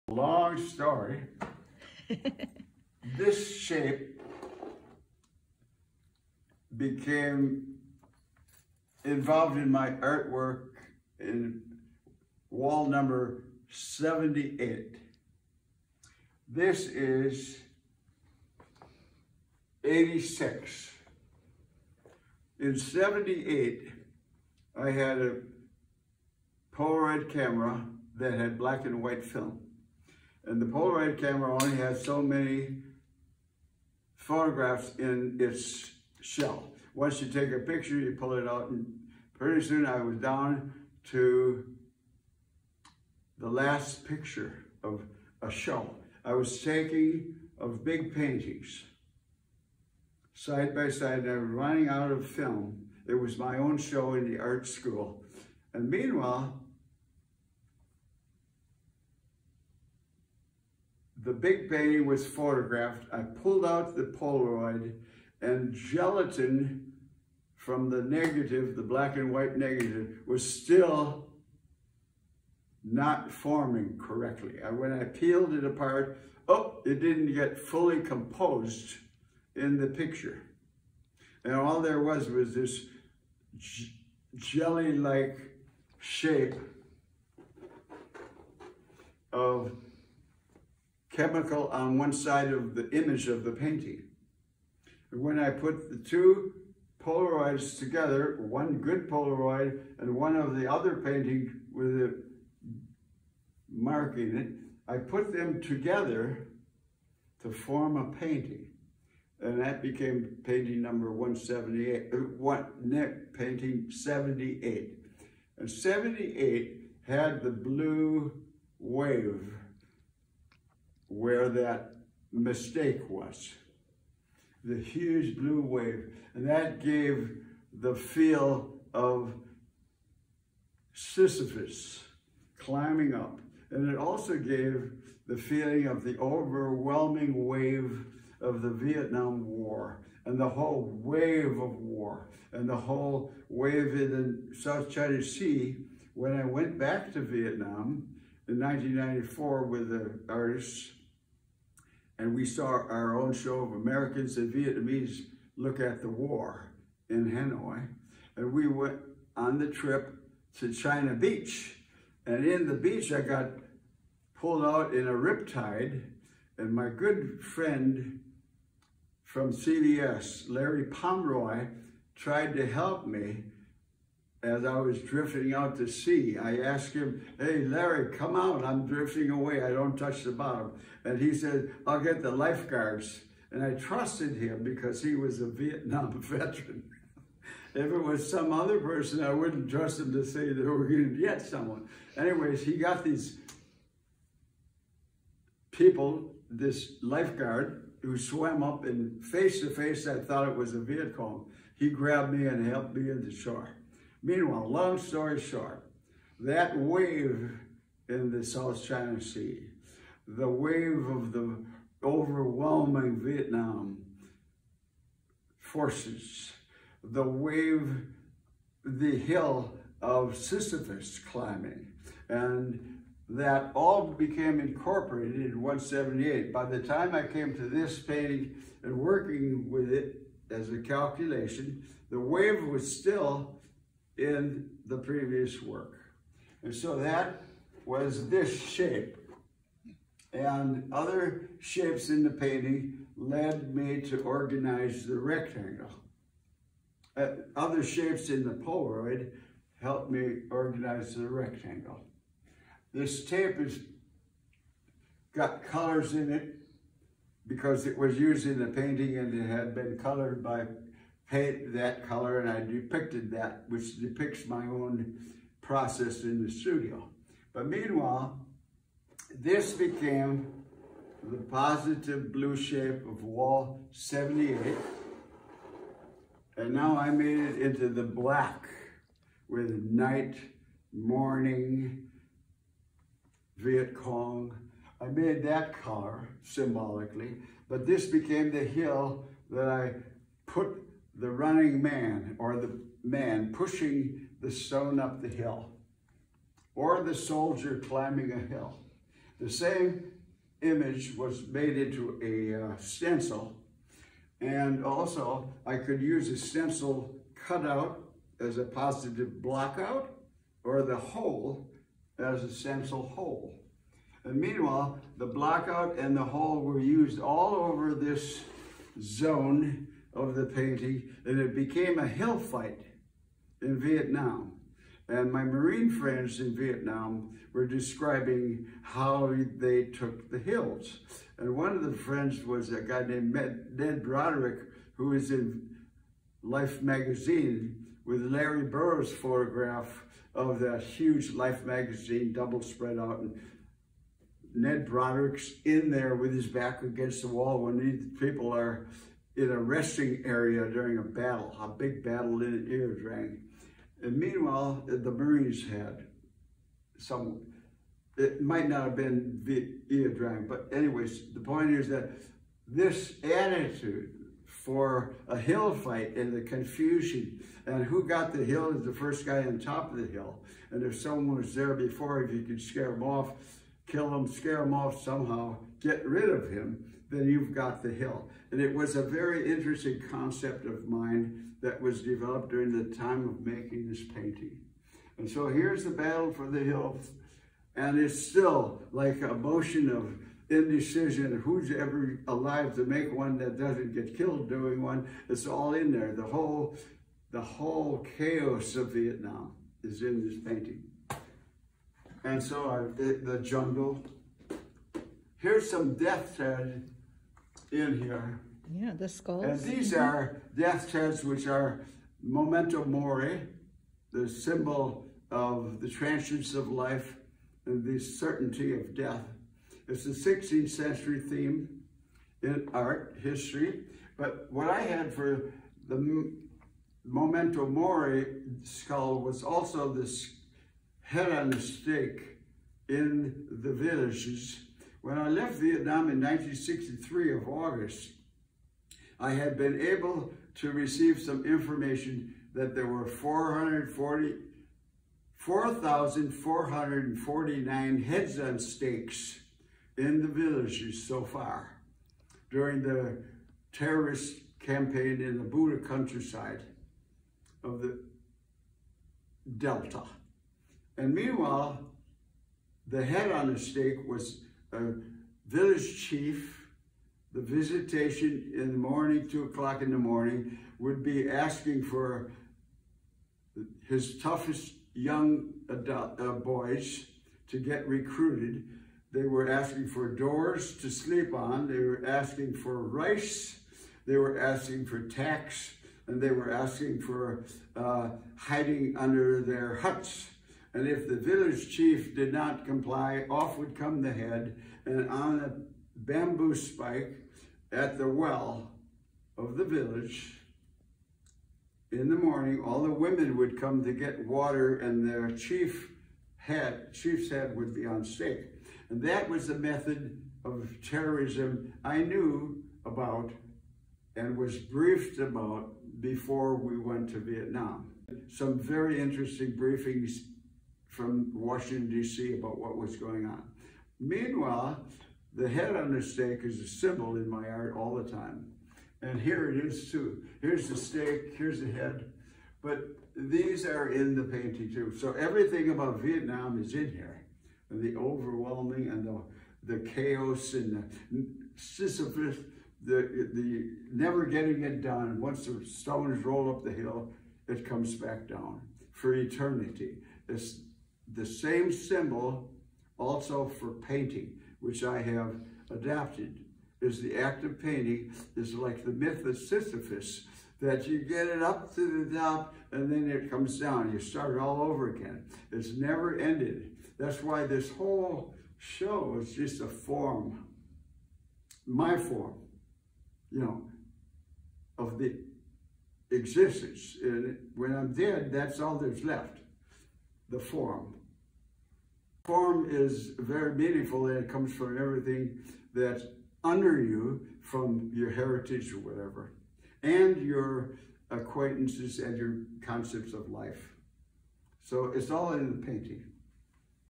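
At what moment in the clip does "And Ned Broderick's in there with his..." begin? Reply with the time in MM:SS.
05:43.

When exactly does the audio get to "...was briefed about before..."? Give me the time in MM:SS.
08:34.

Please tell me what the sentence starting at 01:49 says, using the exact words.
And that became painting number 178, what, uh, Nick, painting 78.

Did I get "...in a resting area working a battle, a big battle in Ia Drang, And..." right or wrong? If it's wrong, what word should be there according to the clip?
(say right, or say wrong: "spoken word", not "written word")
wrong: "during", not "working".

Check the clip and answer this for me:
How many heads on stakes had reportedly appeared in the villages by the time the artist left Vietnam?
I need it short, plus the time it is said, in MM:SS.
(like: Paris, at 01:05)
440, at 07:23.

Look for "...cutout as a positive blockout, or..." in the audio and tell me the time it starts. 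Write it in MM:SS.
05:07.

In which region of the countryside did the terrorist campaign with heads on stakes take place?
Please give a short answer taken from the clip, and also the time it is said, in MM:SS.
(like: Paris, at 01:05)
The Delta, at 07:39.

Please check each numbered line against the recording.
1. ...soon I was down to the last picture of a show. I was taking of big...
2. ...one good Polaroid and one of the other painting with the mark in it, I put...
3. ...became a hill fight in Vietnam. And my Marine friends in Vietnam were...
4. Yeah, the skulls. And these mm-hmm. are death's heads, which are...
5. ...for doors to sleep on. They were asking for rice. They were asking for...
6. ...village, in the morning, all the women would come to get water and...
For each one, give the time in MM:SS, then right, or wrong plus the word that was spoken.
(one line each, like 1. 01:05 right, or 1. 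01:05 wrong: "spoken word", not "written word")
1. 00:39 right
2. 01:38 right
3. 05:21 right
4. 06:48 right
5. 07:59 right
6. 08:19 right.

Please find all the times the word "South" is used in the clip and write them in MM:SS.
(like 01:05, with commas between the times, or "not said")
02:24, 03:28.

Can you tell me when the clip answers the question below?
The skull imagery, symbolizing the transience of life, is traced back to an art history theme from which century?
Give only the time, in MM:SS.
07:00.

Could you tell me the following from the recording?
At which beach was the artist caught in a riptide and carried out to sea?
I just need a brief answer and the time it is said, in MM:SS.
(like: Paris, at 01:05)
China Beach, at 02:40.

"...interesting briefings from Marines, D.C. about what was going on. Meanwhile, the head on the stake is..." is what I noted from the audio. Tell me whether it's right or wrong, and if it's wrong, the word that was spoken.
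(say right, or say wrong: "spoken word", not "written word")
wrong: "Washington", not "Marines".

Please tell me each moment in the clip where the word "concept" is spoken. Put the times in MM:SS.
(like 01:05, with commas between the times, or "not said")
06:20, 09:52.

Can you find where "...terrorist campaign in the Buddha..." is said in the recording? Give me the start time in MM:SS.
07:33.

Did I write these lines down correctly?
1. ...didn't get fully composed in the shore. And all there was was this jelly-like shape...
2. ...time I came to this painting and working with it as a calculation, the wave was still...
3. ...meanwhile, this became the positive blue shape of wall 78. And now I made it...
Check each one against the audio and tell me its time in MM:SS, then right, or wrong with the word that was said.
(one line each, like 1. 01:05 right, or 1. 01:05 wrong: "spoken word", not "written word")
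1. 01:16 wrong: "picture", not "shore"
2. 03:46 right
3. 04:27 right.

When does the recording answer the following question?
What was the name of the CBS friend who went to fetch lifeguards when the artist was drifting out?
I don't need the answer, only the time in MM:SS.
02:50.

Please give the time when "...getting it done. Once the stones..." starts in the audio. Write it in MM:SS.
09:04.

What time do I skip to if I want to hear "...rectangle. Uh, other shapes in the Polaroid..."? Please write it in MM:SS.
04:05.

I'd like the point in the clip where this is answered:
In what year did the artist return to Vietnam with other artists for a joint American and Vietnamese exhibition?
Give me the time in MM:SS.
02:28.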